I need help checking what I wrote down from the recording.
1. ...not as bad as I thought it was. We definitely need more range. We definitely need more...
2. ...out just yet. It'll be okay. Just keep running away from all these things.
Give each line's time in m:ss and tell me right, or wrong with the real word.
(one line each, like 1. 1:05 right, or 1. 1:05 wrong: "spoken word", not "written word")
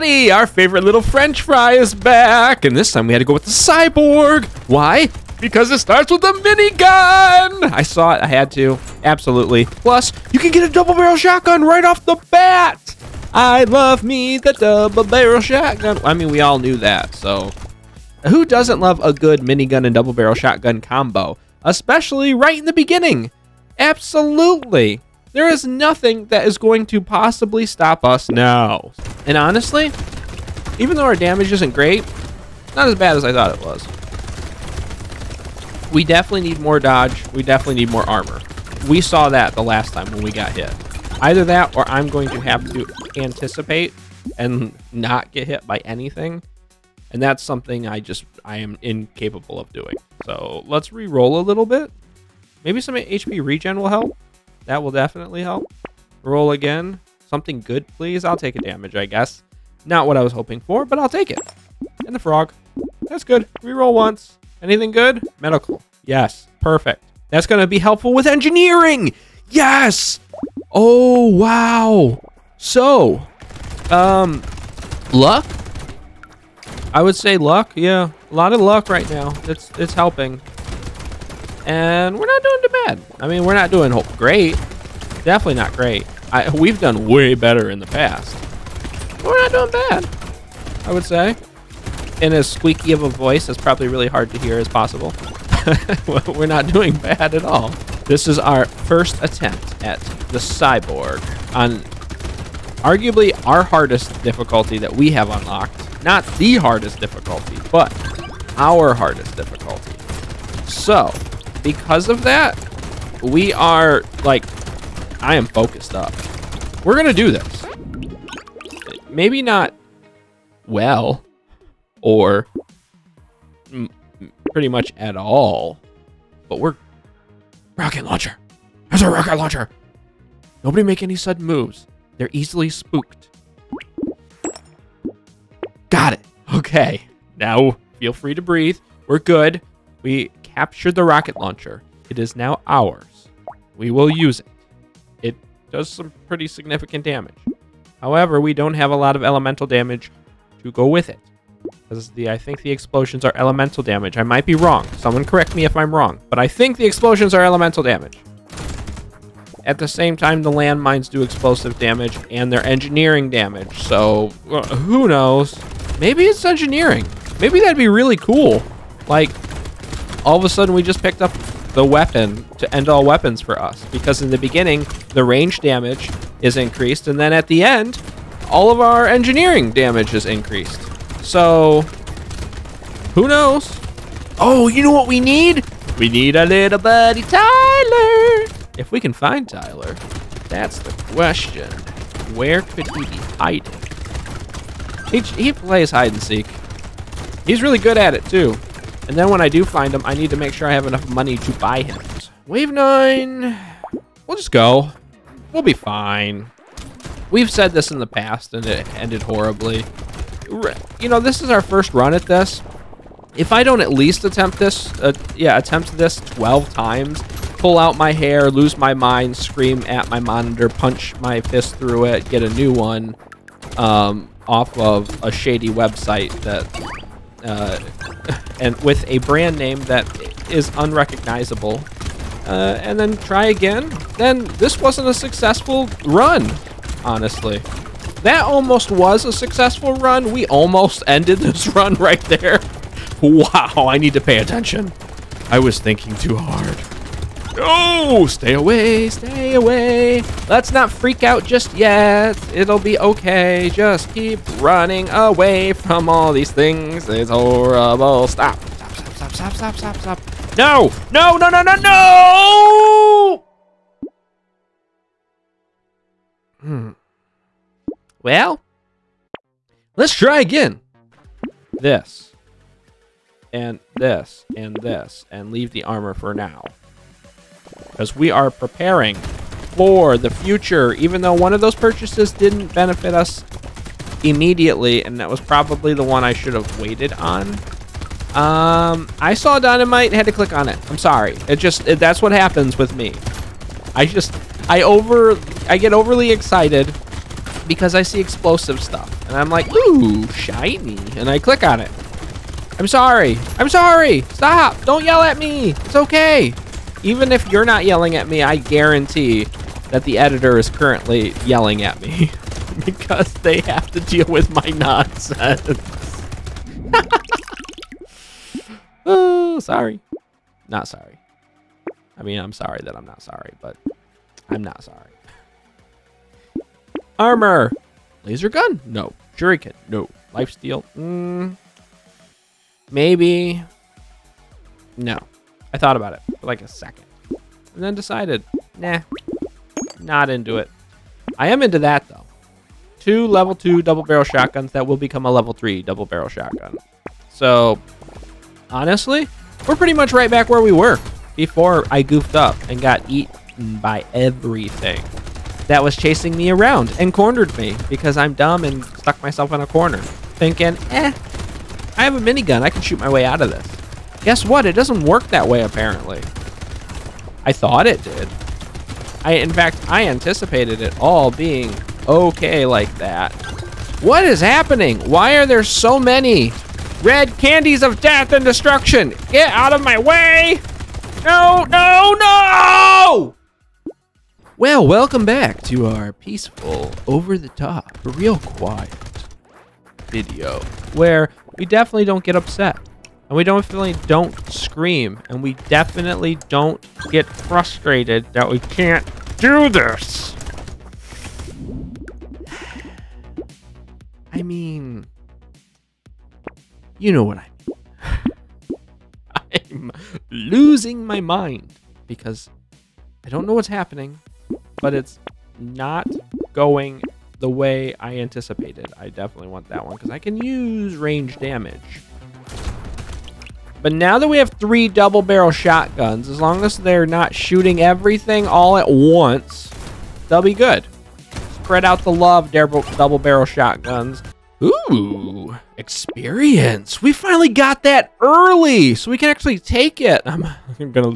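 1. 0:32 wrong: "dodge", not "range"
2. 4:11 right.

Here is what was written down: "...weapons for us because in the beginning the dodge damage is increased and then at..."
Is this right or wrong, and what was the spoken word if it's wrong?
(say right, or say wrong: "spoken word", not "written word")
wrong: "range", not "dodge".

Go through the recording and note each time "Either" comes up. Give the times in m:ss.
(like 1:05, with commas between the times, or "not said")
0:41.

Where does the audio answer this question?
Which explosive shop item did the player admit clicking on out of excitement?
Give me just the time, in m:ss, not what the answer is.
4:49.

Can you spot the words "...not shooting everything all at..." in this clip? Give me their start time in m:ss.
7:07.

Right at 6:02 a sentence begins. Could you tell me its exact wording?
I can shoot my way out of this.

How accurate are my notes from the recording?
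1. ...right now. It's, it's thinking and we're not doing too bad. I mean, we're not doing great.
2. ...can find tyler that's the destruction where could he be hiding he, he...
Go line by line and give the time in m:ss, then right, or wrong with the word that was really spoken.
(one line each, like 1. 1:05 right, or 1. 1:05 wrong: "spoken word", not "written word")
1. 1:18 wrong: "helping", not "thinking"
2. 3:08 wrong: "question", not "destruction".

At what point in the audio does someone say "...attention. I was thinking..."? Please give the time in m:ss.
4:04.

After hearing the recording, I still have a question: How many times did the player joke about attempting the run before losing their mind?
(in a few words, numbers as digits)
12.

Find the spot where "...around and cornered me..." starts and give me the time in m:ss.
5:56.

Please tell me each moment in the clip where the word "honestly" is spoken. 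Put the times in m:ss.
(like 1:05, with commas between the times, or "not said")
0:29, 3:57, 5:48.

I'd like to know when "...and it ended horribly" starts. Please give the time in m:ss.
3:28.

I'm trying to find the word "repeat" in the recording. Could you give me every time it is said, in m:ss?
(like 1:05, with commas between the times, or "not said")
not said.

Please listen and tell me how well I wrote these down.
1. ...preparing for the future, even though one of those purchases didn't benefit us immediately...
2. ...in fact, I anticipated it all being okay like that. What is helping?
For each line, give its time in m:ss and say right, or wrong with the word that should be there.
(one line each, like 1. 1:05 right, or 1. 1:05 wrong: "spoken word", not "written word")
1. 4:38 right
2. 6:09 wrong: "happening", not "helping".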